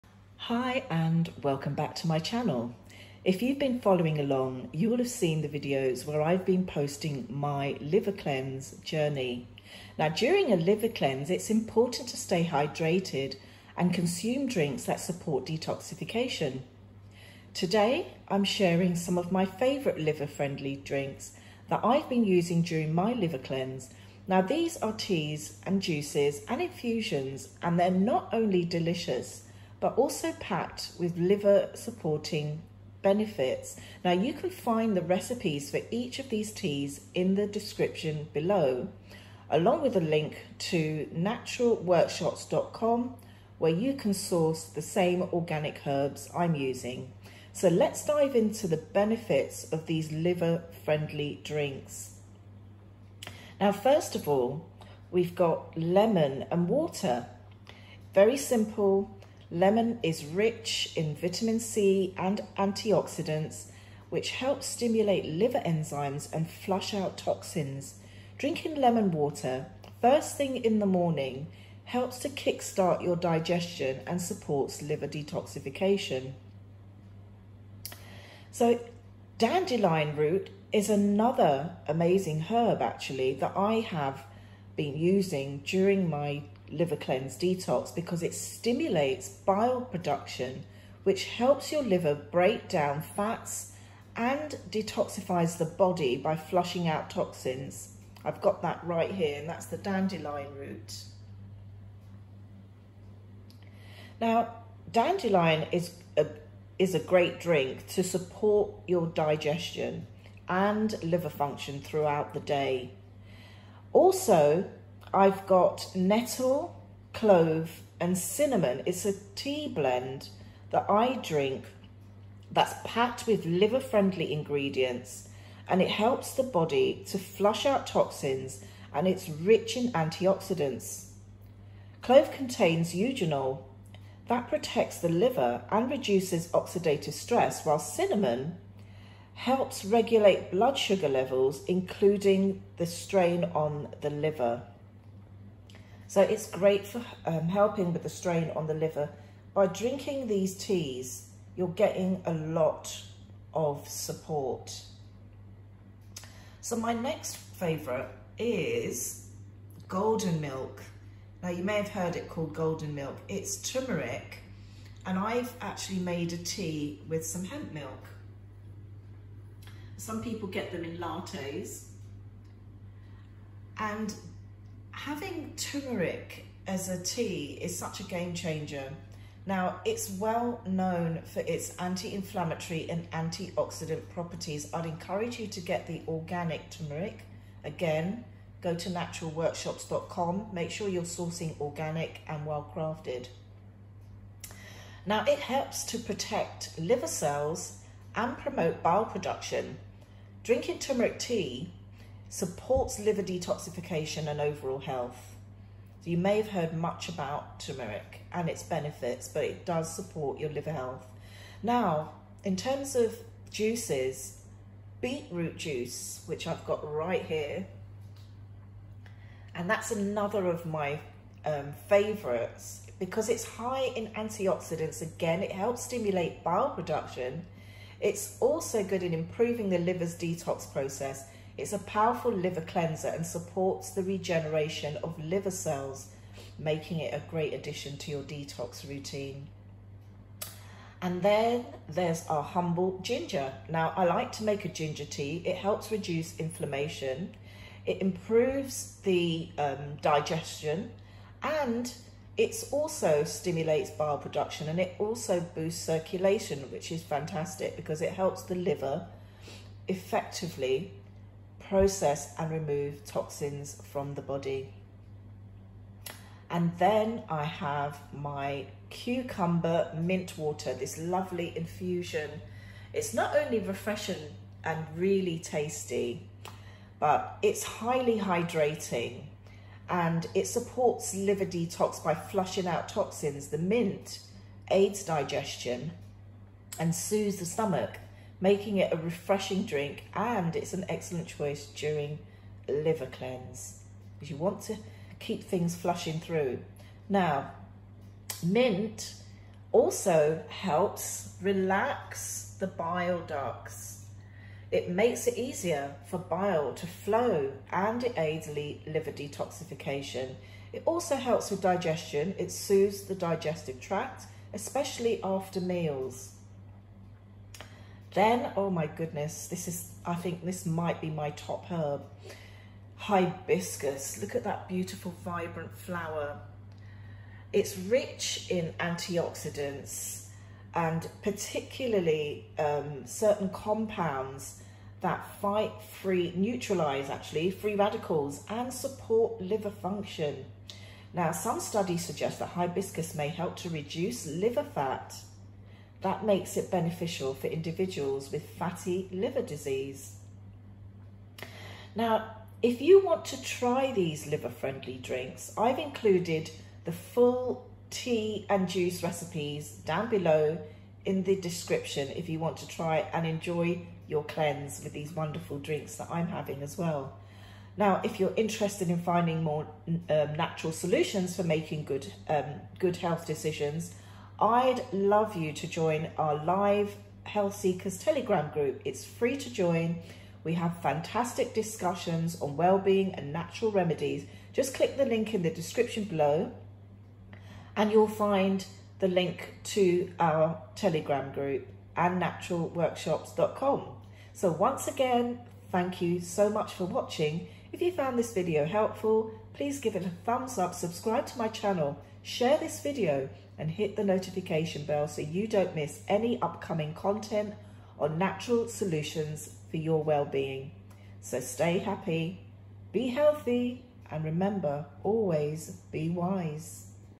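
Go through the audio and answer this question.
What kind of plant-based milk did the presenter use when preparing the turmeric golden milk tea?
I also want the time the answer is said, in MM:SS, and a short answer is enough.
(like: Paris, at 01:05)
hemp milk, at 02:47.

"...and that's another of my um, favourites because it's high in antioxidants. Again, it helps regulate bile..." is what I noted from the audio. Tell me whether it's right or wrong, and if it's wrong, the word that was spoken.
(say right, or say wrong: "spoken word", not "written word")
wrong: "stimulate", not "regulate".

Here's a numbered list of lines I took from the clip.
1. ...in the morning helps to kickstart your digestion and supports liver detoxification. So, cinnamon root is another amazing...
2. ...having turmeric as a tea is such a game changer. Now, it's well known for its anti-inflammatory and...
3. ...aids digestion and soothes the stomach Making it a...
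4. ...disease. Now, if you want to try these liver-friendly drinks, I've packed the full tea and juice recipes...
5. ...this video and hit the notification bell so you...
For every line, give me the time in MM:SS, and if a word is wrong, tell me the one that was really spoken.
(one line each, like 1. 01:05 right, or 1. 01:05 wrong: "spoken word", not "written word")
1. 01:10 wrong: "dandelion", not "cinnamon"
2. 02:55 right
3. 04:44 right
4. 05:49 wrong: "included", not "packed"
5. 06:42 right.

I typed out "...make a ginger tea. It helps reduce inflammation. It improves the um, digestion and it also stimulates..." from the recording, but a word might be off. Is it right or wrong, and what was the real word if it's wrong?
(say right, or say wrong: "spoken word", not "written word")
right.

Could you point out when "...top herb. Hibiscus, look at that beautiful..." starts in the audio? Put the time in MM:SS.
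05:21.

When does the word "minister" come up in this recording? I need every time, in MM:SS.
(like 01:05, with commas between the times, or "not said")
not said.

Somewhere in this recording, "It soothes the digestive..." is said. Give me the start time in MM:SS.
05:12.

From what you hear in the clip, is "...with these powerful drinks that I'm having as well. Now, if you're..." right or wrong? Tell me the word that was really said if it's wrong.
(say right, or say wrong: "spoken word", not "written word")
wrong: "wonderful", not "powerful".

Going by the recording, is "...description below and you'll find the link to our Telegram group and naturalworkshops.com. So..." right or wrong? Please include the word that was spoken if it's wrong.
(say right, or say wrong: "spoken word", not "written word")
right.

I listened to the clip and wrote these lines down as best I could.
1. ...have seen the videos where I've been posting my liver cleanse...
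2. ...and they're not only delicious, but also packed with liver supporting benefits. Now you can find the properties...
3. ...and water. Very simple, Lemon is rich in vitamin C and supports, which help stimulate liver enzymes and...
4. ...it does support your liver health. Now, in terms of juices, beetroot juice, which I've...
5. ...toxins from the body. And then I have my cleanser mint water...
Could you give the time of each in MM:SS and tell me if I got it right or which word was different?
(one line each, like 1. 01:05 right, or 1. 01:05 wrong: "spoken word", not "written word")
1. 00:04 right
2. 00:27 wrong: "recipes", not "properties"
3. 00:56 wrong: "antioxidants", not "supports"
4. 03:29 right
5. 04:23 wrong: "cucumber", not "cleanser".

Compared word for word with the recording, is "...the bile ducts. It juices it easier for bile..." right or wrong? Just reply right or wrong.
wrong.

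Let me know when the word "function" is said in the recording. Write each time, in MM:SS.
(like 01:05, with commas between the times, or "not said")
01:51, 05:39.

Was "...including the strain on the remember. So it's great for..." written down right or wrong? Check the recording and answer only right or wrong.
wrong.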